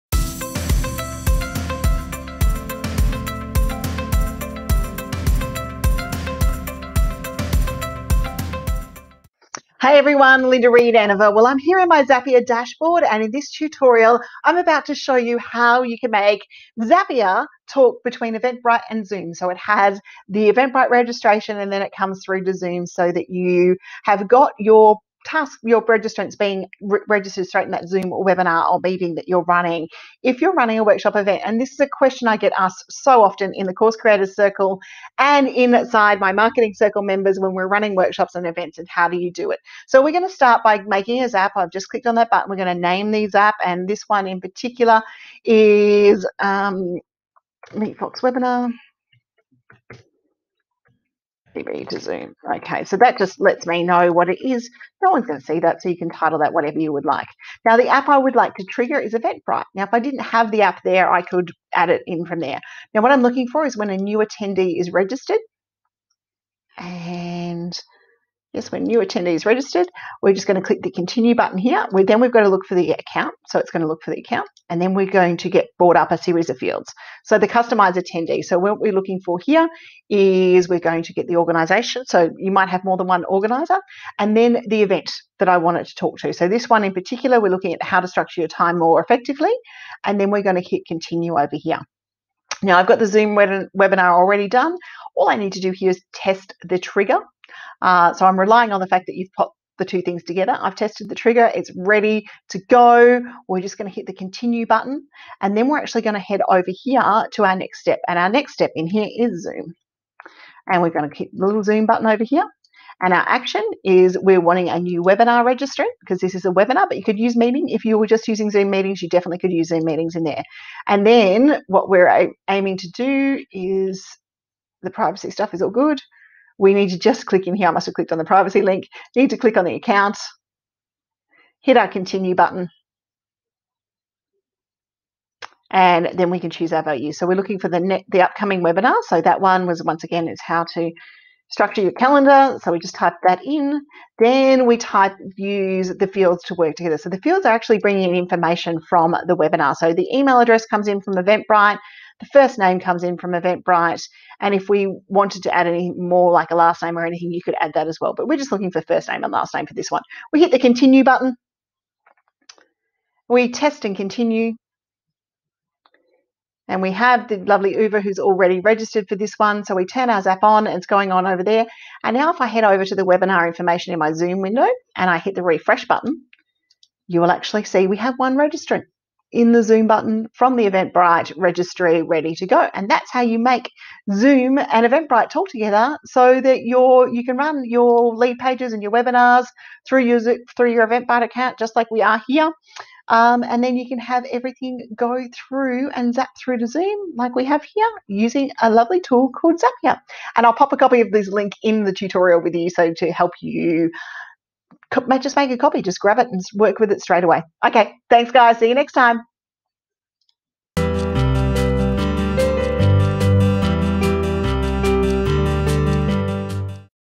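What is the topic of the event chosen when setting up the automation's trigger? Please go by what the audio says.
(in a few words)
How to structure your time more effectively.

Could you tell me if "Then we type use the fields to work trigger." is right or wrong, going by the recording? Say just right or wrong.
wrong.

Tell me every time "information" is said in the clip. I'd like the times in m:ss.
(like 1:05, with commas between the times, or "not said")
2:28, 2:53.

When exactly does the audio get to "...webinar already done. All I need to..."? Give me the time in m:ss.
1:33.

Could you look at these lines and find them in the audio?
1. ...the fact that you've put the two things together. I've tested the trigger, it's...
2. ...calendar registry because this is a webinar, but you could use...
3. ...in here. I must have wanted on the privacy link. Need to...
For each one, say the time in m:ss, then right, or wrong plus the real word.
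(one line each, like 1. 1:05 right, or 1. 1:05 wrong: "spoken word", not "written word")
1. 1:38 right
2. 1:55 wrong: "webinar", not "calendar"
3. 2:07 wrong: "clicked", not "wanted".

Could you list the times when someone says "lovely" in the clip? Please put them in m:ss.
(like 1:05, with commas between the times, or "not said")
2:47, 3:18.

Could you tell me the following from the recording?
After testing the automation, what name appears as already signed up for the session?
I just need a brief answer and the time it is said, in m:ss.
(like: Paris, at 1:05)
Uber, at 2:47.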